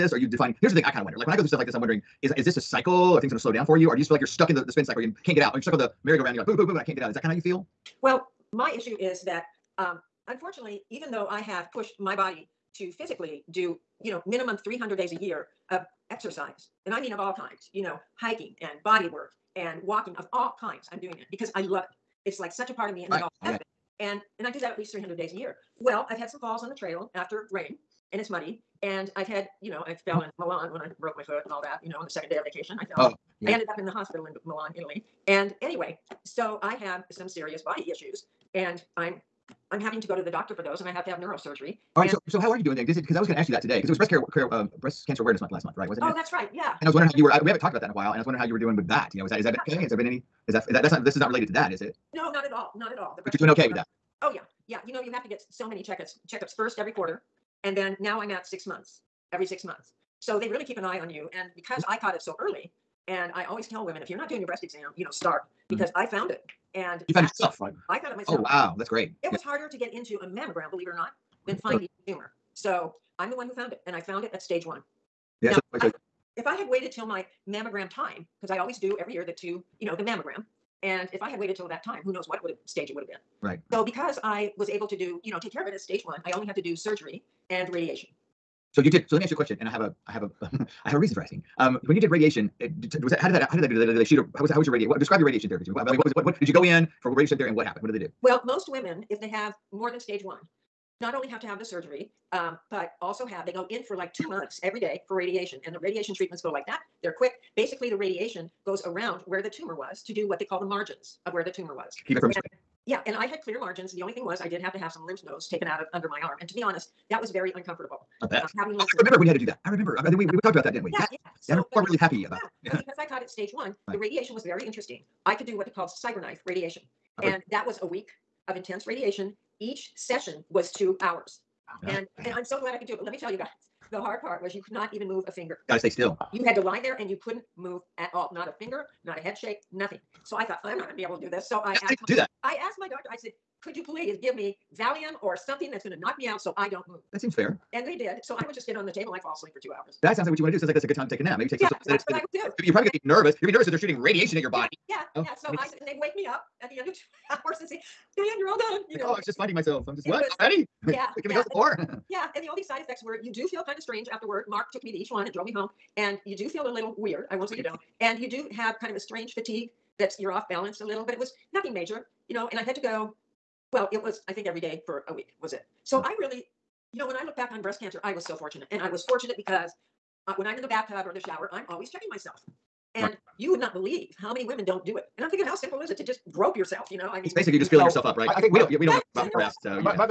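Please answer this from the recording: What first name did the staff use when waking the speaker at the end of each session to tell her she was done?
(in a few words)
Diane.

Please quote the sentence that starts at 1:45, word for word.
And the radiation treatments go like that.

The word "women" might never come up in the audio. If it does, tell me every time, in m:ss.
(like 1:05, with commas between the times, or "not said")
1:03, 1:38, 3:04.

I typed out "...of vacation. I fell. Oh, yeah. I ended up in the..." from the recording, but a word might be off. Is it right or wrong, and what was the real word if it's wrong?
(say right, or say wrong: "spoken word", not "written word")
right.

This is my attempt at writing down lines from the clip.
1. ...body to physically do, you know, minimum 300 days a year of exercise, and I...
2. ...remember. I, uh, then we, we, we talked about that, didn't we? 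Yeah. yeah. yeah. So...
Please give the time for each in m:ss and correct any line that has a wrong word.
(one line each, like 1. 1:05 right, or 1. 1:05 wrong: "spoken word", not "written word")
1. 0:12 right
2. 1:59 right.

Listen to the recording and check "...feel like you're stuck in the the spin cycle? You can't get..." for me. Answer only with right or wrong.
right.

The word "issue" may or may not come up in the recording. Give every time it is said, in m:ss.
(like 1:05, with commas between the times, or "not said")
0:08, 0:37.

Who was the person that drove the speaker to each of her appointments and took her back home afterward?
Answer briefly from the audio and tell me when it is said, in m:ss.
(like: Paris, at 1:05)
Mark, at 2:44.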